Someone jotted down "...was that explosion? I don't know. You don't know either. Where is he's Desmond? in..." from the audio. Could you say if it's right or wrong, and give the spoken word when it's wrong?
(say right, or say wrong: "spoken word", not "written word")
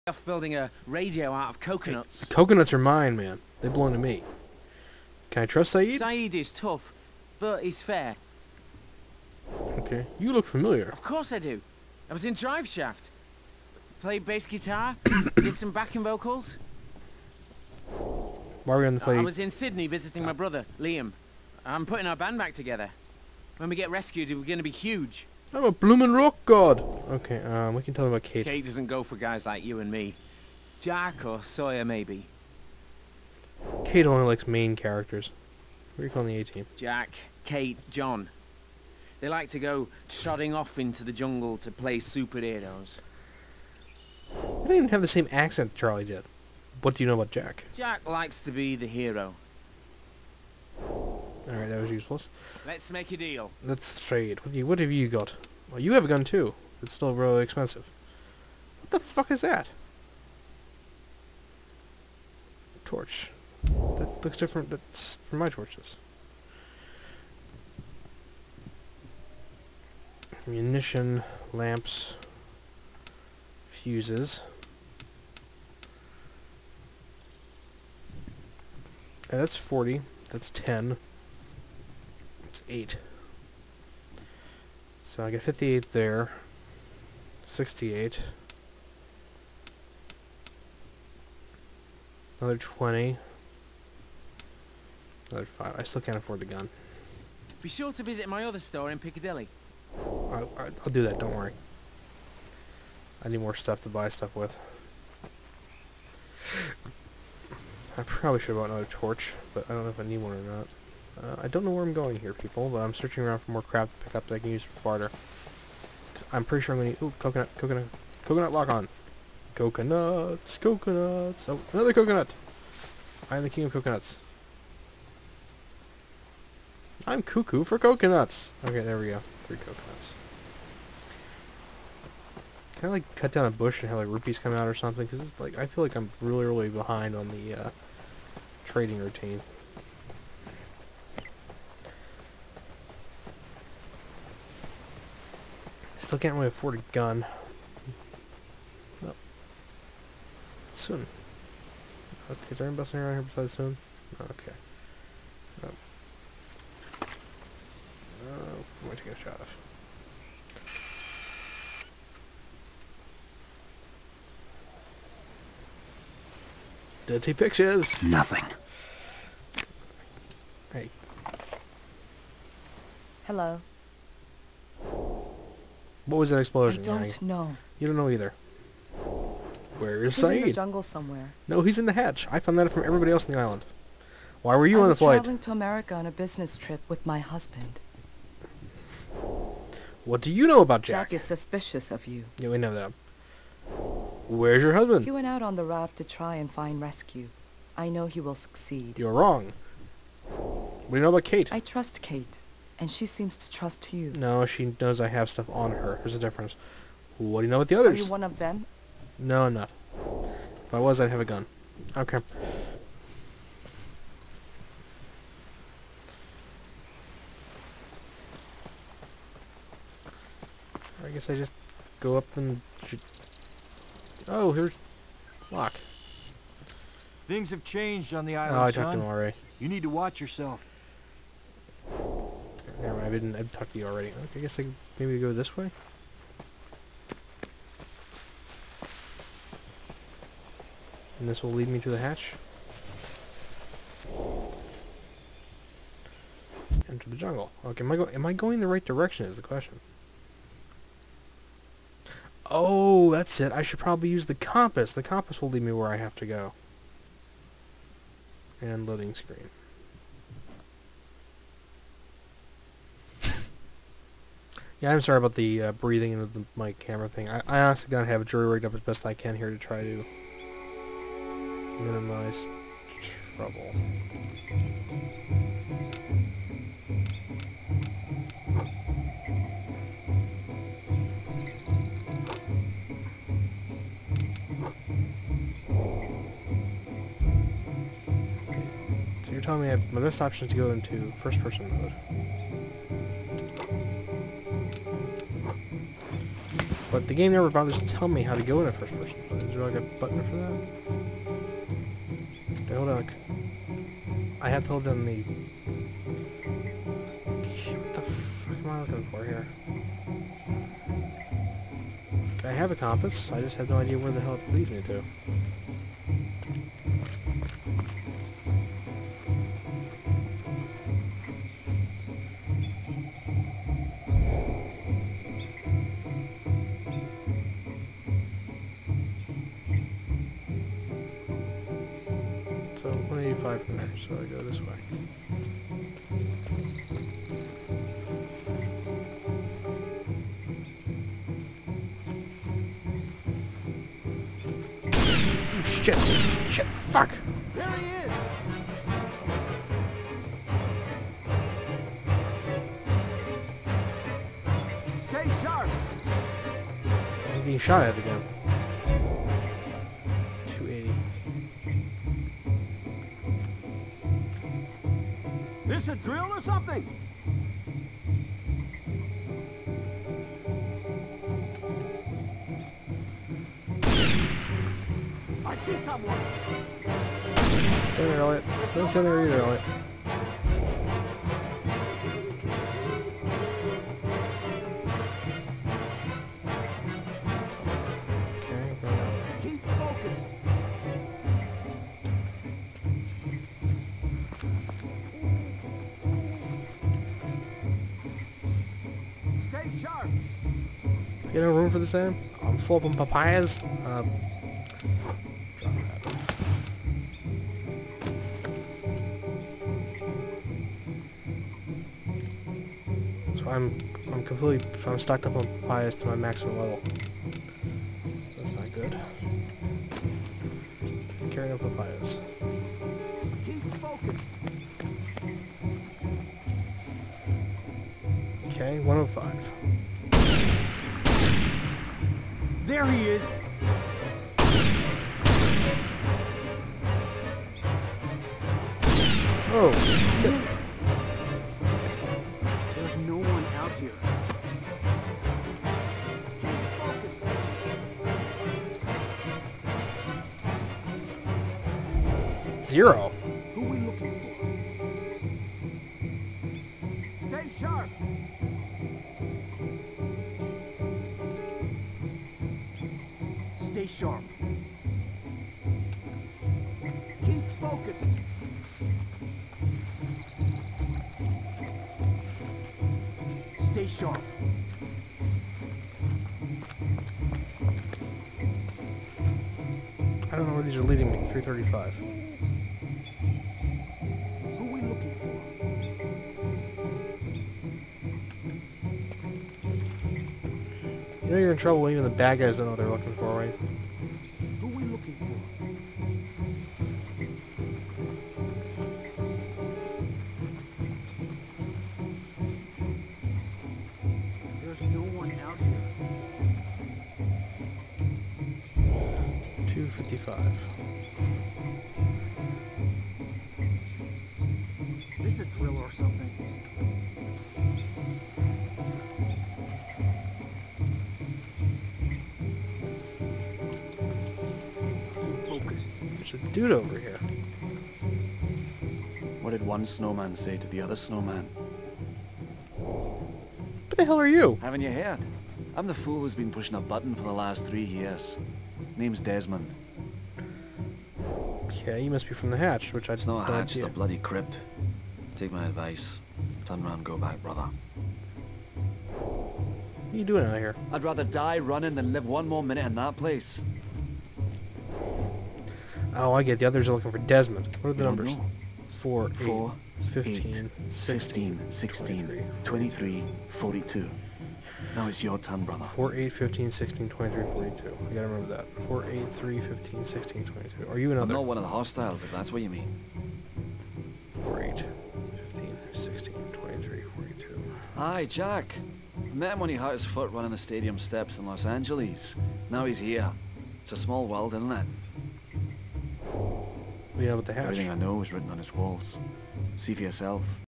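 wrong: "Sayid", not "Desmond".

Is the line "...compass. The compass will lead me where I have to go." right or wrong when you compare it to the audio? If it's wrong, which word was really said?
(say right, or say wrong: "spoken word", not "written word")
right.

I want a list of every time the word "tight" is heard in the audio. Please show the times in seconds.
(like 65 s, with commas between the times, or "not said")
not said.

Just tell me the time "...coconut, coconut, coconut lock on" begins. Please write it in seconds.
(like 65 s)
117 s.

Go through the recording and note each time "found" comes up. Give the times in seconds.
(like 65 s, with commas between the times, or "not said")
182 s.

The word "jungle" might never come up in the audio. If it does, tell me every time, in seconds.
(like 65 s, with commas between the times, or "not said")
41 s, 180 s, 247 s.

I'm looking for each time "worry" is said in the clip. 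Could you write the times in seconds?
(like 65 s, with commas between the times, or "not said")
101 s.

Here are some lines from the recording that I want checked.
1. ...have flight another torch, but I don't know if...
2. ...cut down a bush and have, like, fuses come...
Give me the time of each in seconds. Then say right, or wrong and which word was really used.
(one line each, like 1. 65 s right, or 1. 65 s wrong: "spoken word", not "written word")
1. 108 s wrong: "bought", not "flight"
2. 133 s wrong: "rupees", not "fuses".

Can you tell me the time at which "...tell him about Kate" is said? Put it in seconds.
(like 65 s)
27 s.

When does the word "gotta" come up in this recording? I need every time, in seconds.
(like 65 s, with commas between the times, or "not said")
267 s, 568 s.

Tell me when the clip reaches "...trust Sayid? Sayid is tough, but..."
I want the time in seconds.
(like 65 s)
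5 s.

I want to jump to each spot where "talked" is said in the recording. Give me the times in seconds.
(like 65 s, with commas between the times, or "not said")
228 s, 233 s.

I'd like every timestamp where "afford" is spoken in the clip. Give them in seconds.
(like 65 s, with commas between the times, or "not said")
96 s, 146 s.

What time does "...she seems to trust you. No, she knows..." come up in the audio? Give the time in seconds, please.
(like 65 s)
202 s.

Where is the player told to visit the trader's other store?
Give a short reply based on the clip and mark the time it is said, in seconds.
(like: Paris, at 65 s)
Piccadilly, at 98 s.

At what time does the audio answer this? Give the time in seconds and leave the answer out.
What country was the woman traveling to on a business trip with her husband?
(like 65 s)
185 s.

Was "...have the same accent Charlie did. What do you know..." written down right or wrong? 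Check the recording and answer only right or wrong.
right.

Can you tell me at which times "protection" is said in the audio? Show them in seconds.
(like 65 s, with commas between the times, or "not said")
not said.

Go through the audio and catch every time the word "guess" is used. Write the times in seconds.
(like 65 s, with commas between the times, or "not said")
221 s, 234 s.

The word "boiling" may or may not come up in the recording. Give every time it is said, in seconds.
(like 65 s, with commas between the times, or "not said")
not said.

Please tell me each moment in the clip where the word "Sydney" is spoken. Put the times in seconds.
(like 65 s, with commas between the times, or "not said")
19 s.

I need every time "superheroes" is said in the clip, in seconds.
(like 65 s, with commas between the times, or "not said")
41 s.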